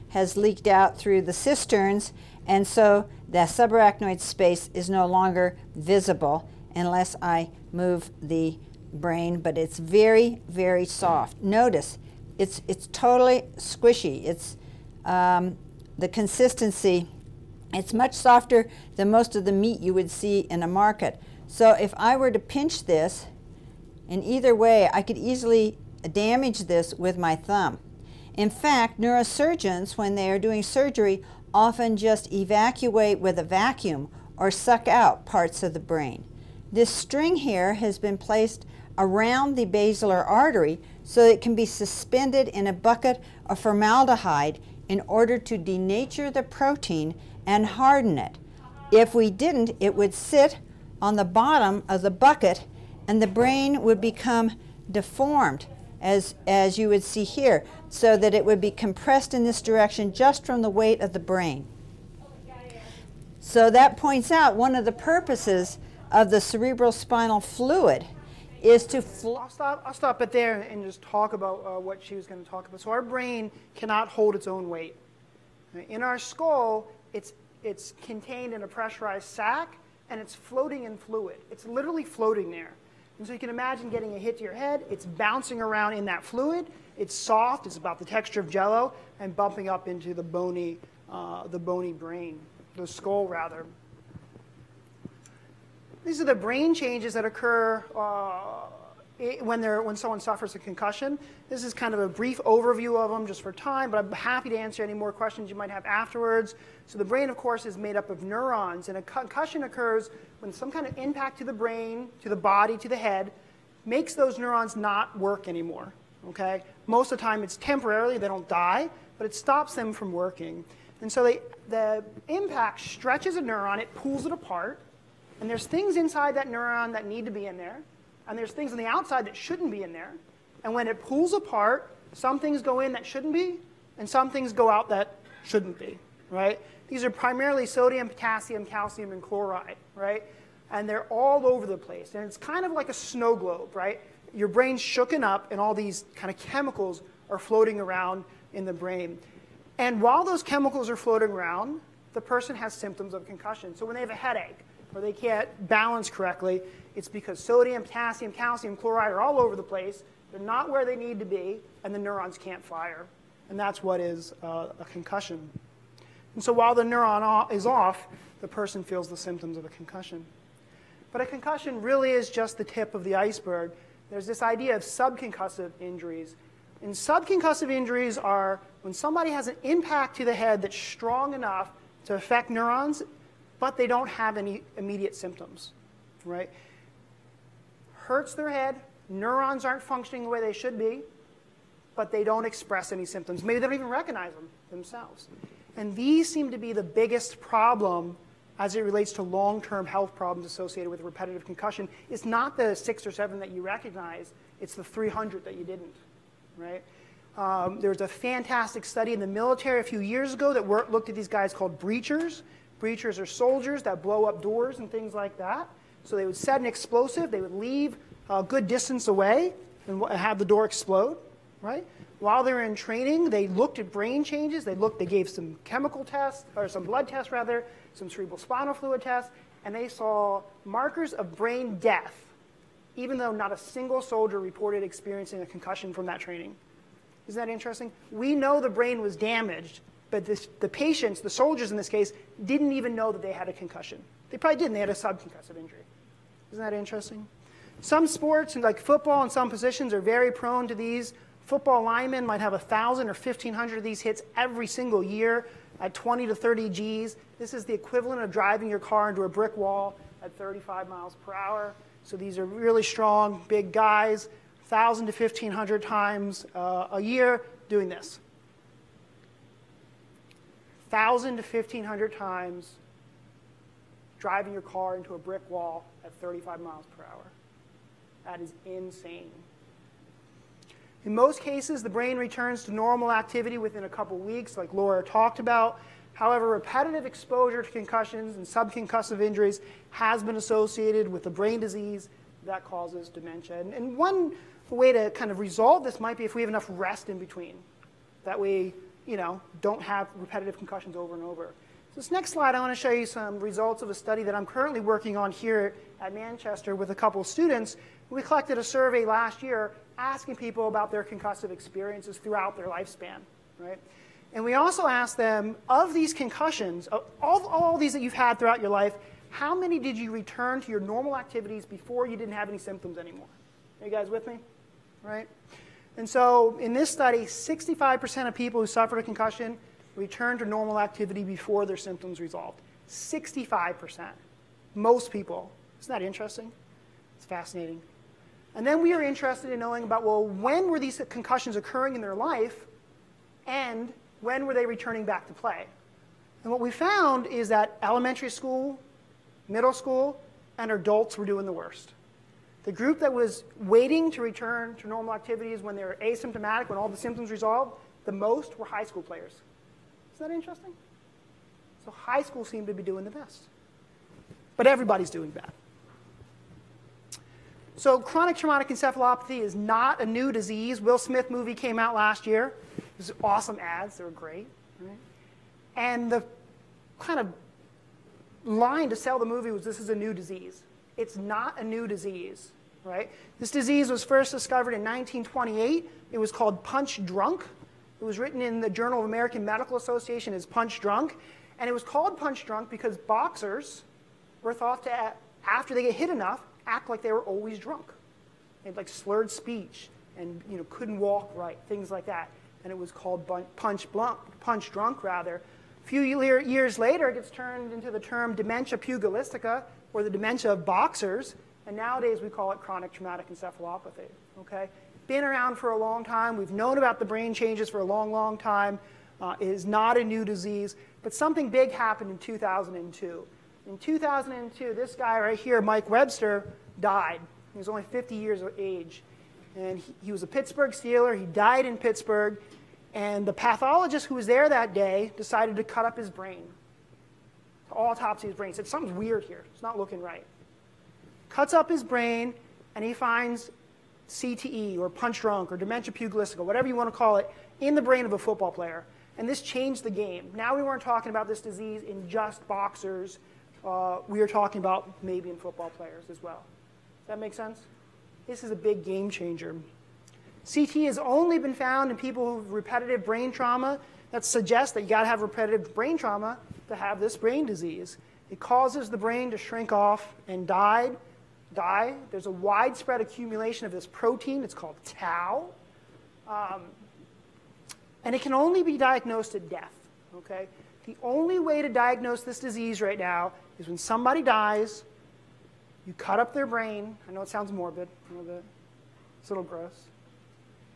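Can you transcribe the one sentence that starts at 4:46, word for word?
However, repetitive exposure to concussions and subconcussive injuries has been associated with a brain disease that causes dementia.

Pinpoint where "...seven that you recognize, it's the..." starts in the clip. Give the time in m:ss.
3:23.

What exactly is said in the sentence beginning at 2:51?
But a concussion really is just the tip of the iceberg.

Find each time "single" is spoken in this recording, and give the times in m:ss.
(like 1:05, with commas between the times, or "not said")
3:53, 4:14.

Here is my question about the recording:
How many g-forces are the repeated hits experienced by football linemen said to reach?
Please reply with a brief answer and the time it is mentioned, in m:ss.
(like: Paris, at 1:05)
20 to 30 Gs, at 4:15.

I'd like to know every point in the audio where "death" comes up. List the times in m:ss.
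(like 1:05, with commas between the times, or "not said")
3:51, 7:59.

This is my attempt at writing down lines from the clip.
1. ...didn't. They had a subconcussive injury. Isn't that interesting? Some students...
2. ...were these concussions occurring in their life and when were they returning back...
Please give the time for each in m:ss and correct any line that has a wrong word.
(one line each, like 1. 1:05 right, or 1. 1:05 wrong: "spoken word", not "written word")
1. 4:04 wrong: "sports", not "students"
2. 5:40 right.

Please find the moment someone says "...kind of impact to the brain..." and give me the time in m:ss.
1:50.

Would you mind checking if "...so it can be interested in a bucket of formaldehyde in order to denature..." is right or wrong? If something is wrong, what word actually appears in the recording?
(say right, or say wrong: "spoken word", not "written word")
wrong: "suspended", not "interested".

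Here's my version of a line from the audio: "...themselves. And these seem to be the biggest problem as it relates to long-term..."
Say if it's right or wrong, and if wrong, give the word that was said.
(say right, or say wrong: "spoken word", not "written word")
right.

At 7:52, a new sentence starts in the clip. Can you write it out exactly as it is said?
There's a widespread accumulation of this protein.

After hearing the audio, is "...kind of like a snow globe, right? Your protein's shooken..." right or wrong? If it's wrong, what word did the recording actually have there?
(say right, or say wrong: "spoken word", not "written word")
wrong: "brain", not "protein".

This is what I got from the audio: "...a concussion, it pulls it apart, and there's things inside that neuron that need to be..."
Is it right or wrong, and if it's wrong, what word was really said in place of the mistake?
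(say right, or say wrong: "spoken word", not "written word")
wrong: "neuron", not "concussion".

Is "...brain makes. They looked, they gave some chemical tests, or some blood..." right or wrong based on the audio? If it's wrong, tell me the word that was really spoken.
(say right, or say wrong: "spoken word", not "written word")
wrong: "changes", not "makes".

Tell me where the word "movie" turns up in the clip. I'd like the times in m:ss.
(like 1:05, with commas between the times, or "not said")
6:11, 6:19.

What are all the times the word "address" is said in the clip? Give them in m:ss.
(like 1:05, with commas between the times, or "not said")
not said.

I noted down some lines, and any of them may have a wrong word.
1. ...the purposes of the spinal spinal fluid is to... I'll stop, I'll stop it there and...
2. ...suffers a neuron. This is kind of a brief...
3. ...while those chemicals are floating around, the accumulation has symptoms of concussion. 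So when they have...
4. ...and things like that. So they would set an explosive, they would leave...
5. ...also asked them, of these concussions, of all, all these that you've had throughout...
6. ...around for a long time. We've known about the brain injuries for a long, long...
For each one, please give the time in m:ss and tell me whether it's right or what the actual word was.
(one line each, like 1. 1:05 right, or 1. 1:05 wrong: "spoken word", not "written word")
1. 1:04 wrong: "cerebral", not "spinal"
2. 1:40 wrong: "concussion", not "neuron"
3. 2:30 wrong: "person", not "accumulation"
4. 3:34 right
5. 5:14 right
6. 6:55 wrong: "changes", not "injuries".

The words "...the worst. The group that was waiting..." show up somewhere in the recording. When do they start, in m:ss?
5:51.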